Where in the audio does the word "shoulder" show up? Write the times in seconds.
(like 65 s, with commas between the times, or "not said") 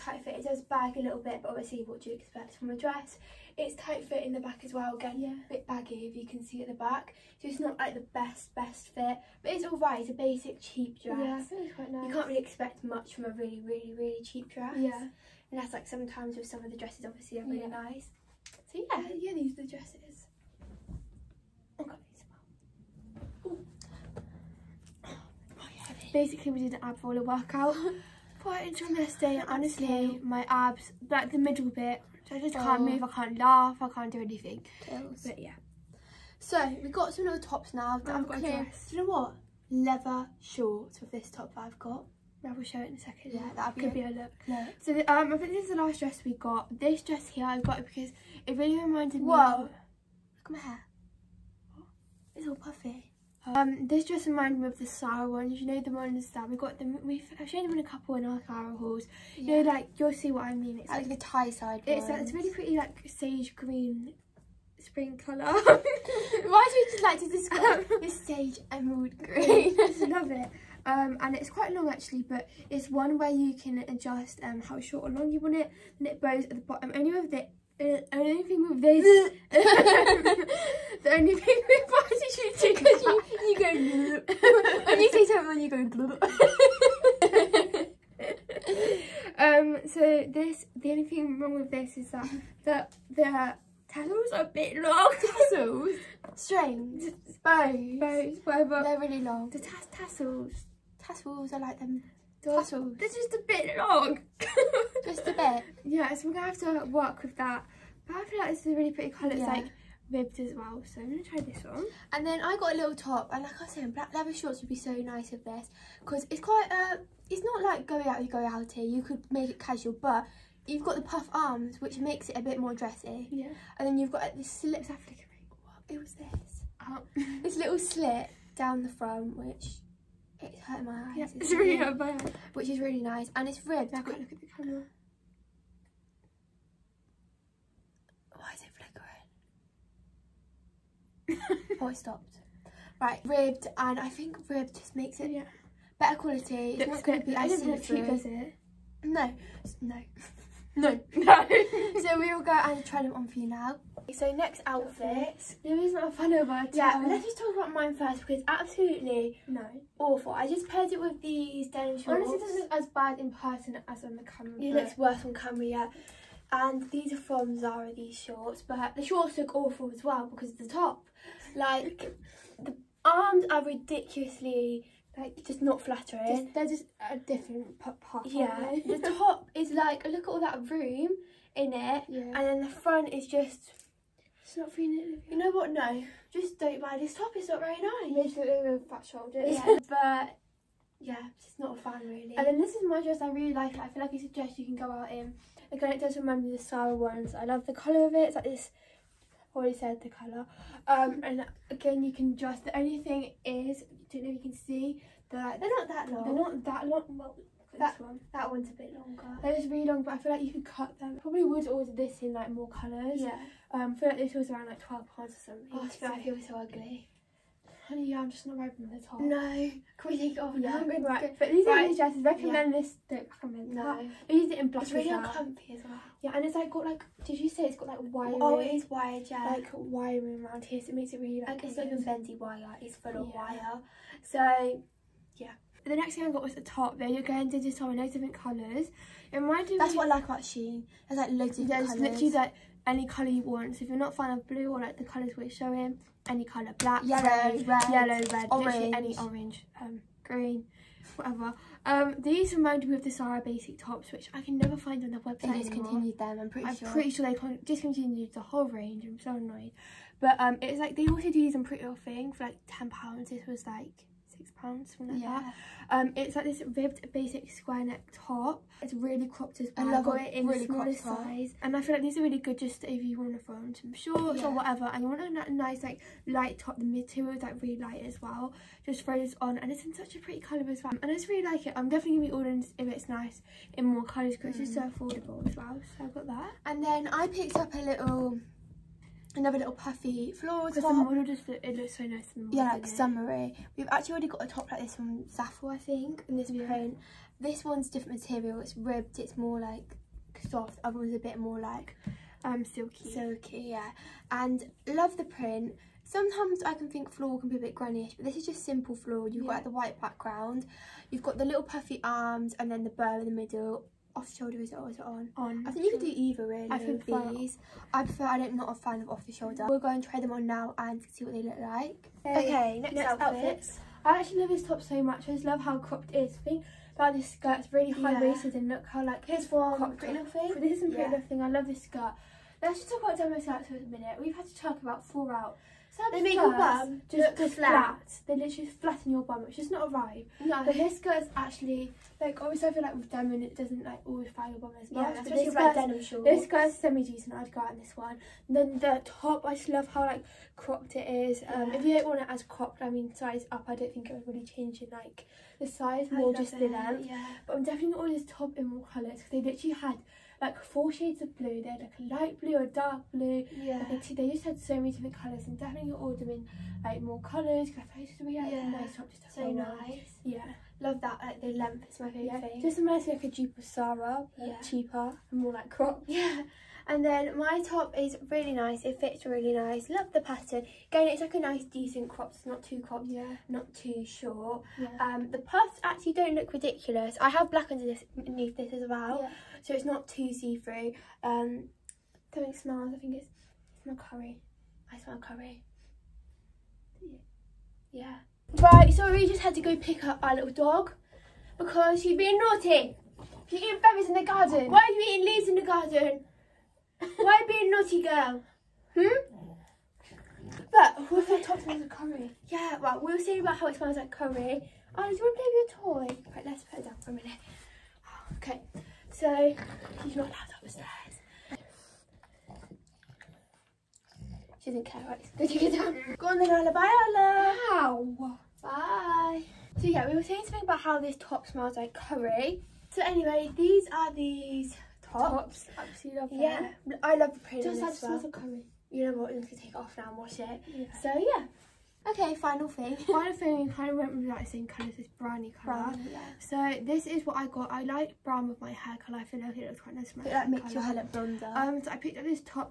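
189 s, 314 s, 319 s.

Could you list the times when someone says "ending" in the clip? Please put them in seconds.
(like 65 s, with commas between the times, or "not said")
not said.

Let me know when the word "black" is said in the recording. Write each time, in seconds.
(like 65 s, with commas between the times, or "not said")
113 s, 224 s, 246 s, 387 s.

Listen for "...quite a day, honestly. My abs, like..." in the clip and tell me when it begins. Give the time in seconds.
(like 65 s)
28 s.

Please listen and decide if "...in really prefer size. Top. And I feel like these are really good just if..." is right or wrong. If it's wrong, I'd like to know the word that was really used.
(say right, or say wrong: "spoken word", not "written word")
wrong: "smaller", not "prefer".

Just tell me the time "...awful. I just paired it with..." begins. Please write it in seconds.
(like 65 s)
159 s.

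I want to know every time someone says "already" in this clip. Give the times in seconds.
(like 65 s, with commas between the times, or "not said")
199 s, 294 s.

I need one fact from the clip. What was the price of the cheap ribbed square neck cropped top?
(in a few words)
£6.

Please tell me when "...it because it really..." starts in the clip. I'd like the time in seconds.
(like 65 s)
47 s.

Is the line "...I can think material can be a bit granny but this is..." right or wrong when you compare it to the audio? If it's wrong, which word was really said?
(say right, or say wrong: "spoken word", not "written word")
wrong: "floral", not "material".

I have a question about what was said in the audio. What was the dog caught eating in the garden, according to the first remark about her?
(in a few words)
berries.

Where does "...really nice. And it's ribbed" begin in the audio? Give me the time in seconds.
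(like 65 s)
132 s.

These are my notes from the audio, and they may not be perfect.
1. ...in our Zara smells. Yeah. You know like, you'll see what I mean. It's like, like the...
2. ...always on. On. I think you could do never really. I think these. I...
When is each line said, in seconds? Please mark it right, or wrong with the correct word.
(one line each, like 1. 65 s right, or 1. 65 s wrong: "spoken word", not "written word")
1. 58 s wrong: "halls", not "smells"
2. 314 s wrong: "either", not "never".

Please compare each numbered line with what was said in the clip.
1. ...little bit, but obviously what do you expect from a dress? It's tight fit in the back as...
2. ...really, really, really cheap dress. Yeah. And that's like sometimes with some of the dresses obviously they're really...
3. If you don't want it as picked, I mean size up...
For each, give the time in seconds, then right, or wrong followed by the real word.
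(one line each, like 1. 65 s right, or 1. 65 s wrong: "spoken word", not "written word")
1. 0 s right
2. 13 s right
3. 351 s wrong: "cropped", not "picked".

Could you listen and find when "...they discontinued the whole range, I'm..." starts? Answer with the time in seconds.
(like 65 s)
257 s.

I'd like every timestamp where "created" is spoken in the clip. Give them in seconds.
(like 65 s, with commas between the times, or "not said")
not said.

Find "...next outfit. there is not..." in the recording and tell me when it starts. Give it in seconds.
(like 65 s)
154 s.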